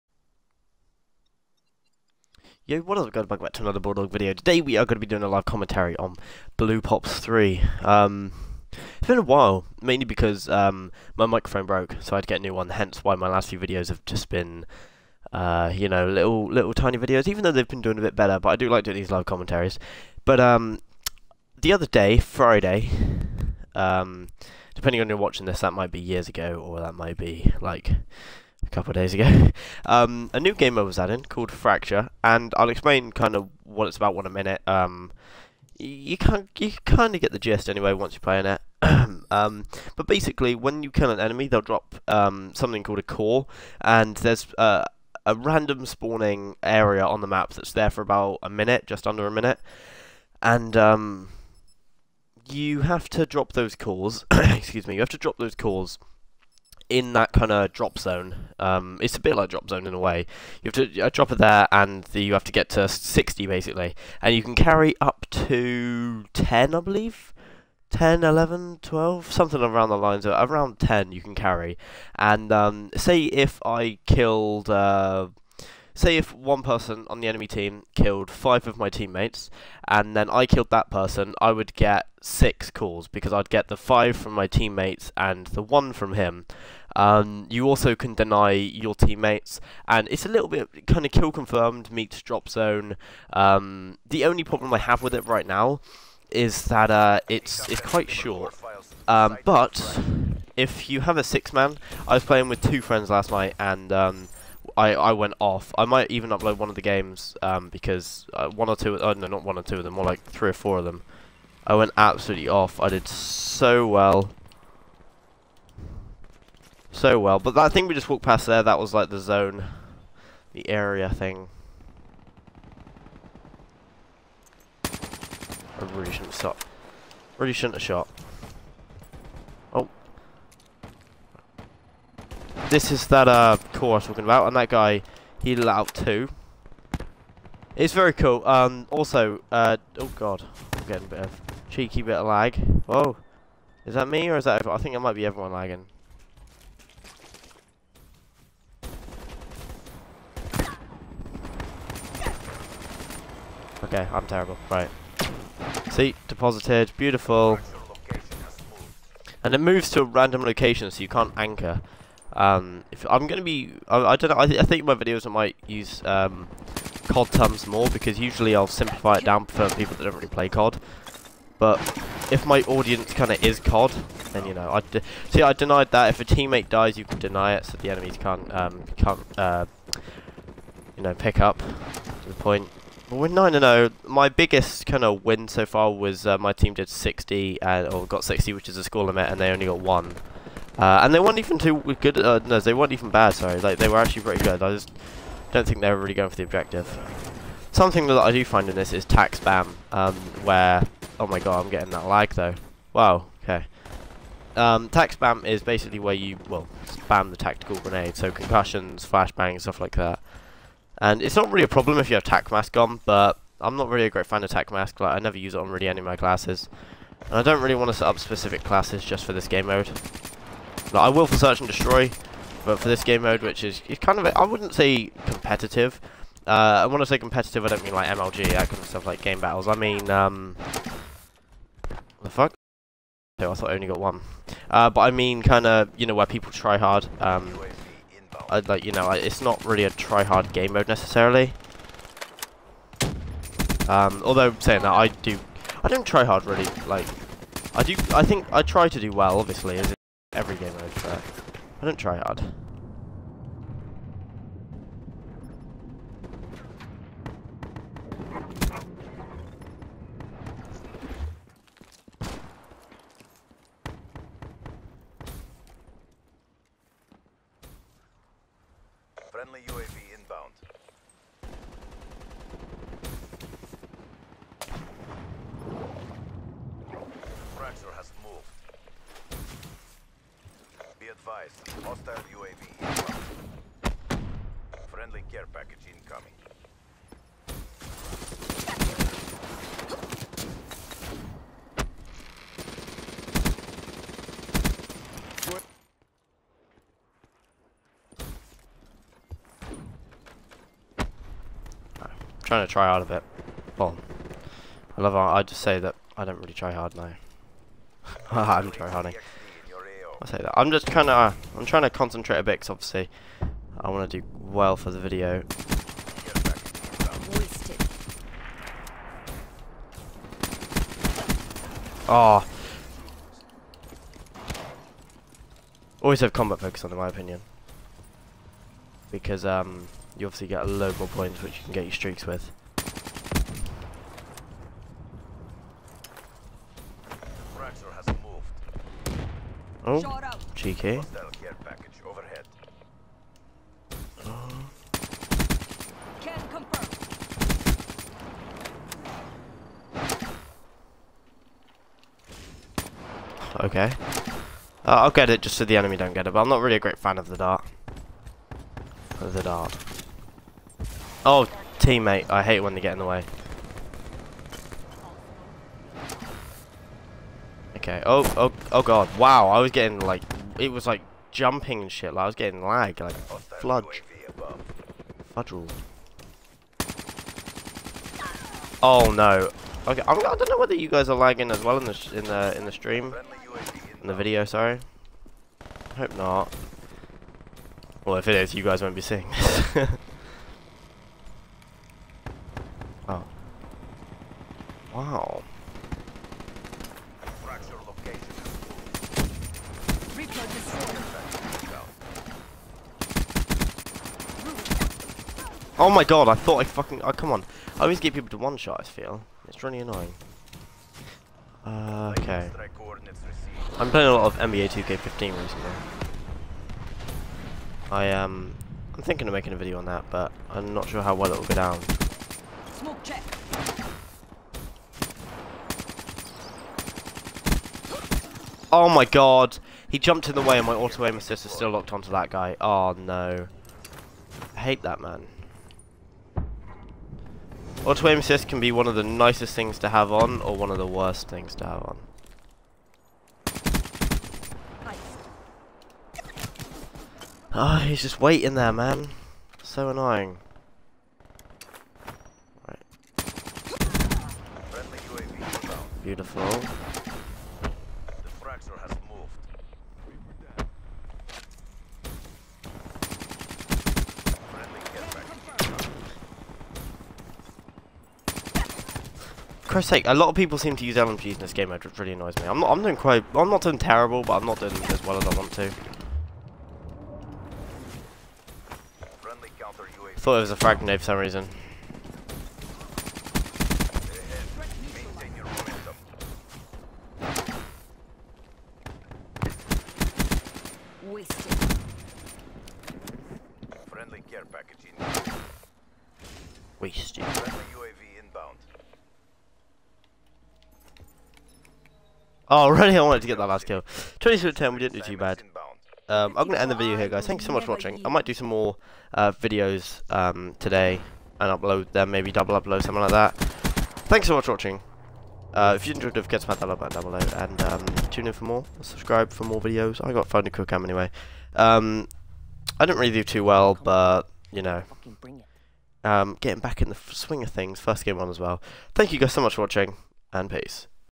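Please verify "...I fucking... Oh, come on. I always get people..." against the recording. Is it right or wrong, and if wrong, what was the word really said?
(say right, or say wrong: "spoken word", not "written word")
right.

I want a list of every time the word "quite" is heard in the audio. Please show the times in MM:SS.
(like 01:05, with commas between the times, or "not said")
01:37, 07:52.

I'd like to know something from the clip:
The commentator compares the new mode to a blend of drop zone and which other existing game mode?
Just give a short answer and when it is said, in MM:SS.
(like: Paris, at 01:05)
kill confirmed, at 01:31.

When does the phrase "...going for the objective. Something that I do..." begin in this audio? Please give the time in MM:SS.
03:16.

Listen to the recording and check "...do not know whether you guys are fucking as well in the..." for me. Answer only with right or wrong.
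wrong.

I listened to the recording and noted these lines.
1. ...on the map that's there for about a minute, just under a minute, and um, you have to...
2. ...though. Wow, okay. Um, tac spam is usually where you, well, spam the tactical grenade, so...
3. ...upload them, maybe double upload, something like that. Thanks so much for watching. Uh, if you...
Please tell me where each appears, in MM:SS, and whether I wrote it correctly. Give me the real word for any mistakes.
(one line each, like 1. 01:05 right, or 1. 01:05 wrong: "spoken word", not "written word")
1. 00:47 right
2. 03:22 wrong: "basically", not "usually"
3. 08:31 right.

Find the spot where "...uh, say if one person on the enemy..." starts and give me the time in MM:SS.
01:14.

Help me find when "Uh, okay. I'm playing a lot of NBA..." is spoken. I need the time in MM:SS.
06:51.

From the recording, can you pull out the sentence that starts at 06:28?
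Well, if it is, you guys won't be seeing this.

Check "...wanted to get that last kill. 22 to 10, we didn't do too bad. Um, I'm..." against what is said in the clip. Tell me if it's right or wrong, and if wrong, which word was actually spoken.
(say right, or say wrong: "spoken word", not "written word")
right.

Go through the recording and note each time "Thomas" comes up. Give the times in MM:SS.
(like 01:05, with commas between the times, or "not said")
not said.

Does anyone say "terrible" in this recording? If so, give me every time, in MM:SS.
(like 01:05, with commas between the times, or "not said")
02:34, 07:53.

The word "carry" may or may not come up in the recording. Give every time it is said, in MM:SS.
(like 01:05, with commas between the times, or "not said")
01:04, 01:11.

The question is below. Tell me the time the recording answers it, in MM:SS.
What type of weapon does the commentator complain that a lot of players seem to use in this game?
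07:50.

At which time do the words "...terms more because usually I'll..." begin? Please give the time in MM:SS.
02:47.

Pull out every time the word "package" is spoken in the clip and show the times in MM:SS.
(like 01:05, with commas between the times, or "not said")
04:45.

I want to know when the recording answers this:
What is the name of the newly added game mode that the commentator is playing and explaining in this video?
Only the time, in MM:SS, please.
00:31.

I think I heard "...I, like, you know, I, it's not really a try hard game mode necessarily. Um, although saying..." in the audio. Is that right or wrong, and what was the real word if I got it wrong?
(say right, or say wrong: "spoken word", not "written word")
right.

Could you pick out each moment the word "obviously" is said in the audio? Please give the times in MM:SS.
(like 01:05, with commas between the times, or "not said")
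04:09, 05:12, 05:30.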